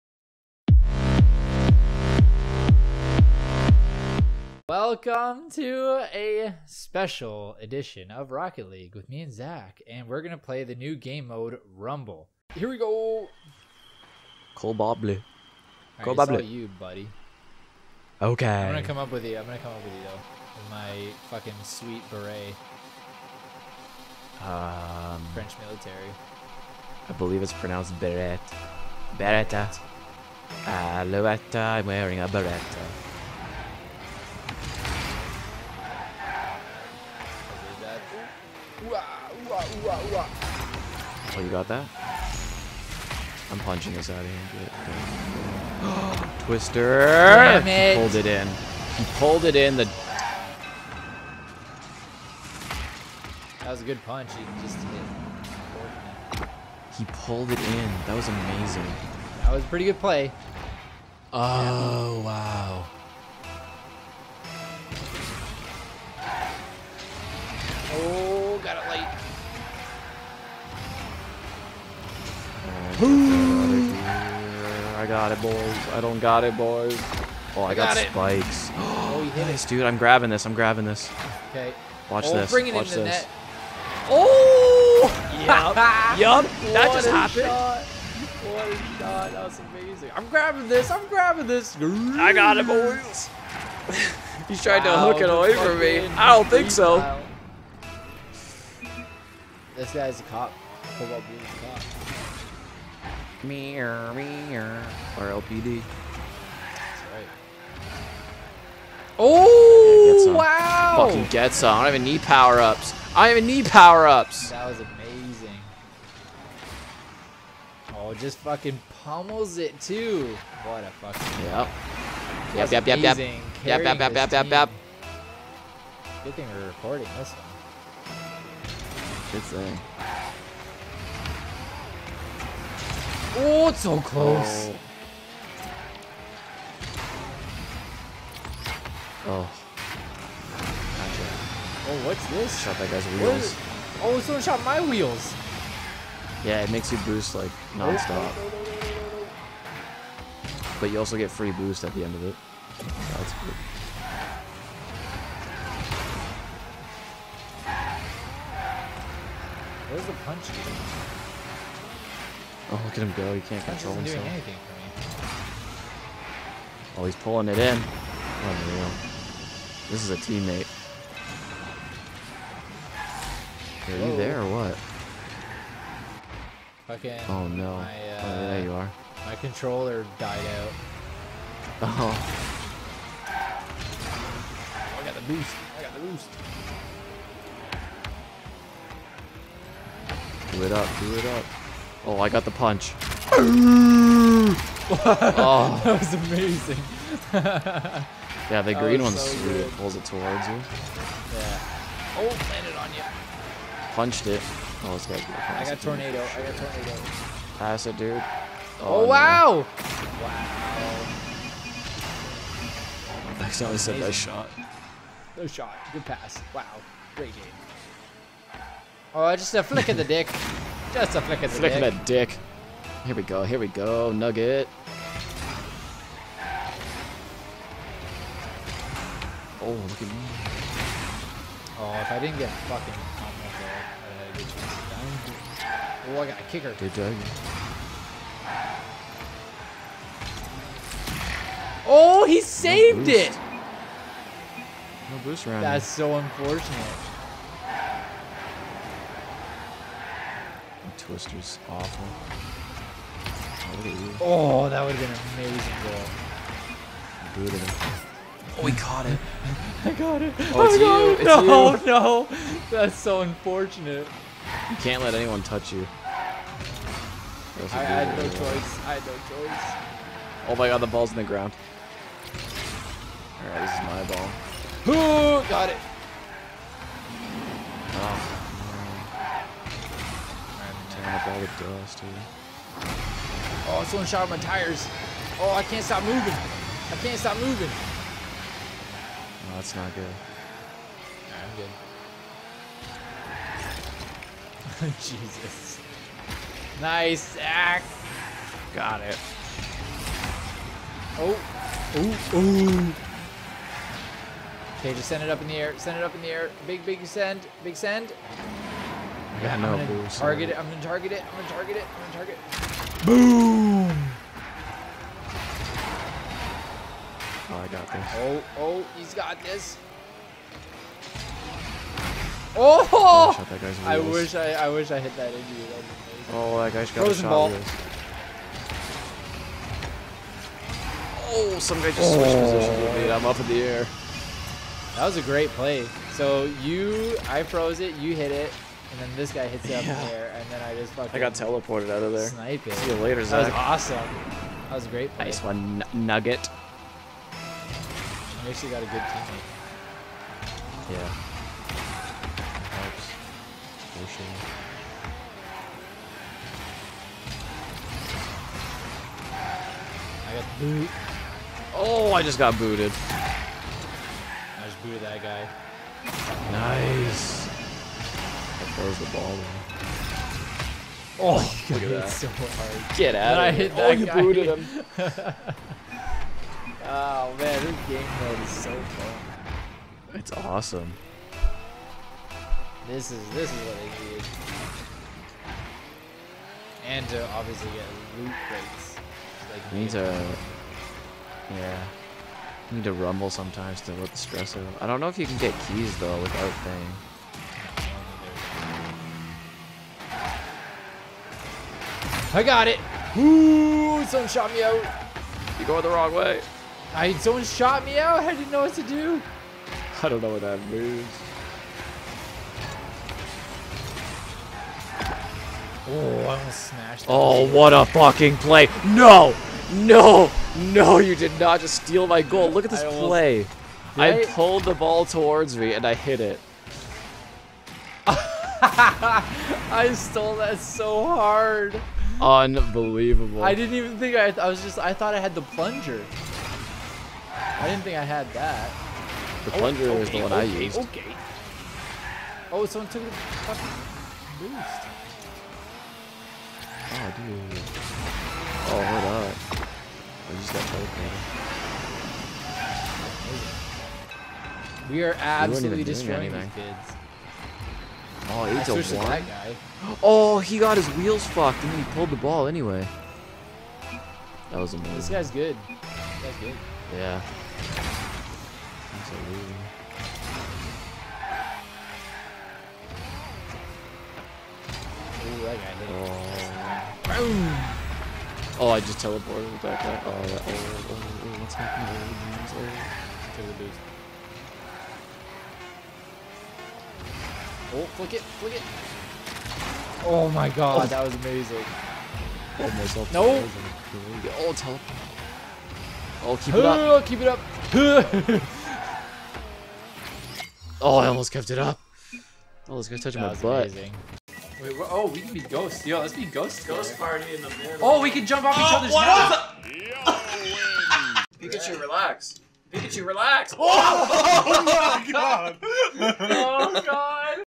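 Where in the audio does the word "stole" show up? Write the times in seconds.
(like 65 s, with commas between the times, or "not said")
429 s.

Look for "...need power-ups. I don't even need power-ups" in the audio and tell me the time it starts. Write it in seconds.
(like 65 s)
112 s.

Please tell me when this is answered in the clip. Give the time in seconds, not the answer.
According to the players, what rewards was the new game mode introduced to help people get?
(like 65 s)
388 s.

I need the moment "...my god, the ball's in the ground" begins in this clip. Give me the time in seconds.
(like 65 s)
270 s.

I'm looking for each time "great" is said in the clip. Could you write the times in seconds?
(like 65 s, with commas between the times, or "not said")
217 s, 335 s, 344 s.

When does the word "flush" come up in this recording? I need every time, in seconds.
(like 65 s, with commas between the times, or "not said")
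not said.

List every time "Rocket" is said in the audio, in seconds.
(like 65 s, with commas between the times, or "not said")
8 s.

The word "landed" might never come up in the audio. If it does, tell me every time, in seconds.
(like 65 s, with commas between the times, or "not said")
202 s.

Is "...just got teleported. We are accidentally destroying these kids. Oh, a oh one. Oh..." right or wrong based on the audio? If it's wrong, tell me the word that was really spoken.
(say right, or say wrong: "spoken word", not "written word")
wrong: "absolutely", not "accidentally".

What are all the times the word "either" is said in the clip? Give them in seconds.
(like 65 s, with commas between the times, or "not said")
not said.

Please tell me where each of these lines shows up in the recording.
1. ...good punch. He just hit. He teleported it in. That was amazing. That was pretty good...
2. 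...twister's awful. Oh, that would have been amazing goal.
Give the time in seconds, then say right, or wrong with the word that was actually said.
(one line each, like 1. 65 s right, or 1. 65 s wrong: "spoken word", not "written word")
1. 53 s wrong: "pulled", not "teleported"
2. 251 s right.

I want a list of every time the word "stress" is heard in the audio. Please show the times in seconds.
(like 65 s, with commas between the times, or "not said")
394 s.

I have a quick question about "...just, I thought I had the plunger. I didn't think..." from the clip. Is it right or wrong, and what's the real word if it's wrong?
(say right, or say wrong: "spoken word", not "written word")
right.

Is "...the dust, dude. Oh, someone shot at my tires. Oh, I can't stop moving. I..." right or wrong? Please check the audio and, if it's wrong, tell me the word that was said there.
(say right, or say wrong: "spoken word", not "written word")
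right.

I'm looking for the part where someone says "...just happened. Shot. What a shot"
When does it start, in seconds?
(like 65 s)
86 s.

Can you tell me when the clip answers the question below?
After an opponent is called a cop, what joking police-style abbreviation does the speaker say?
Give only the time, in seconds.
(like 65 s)
105 s.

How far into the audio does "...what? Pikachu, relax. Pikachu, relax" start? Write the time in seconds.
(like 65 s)
510 s.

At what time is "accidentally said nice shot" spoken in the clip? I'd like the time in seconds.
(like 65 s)
213 s.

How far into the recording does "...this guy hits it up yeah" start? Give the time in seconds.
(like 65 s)
339 s.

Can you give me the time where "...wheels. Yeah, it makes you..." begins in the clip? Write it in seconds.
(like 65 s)
144 s.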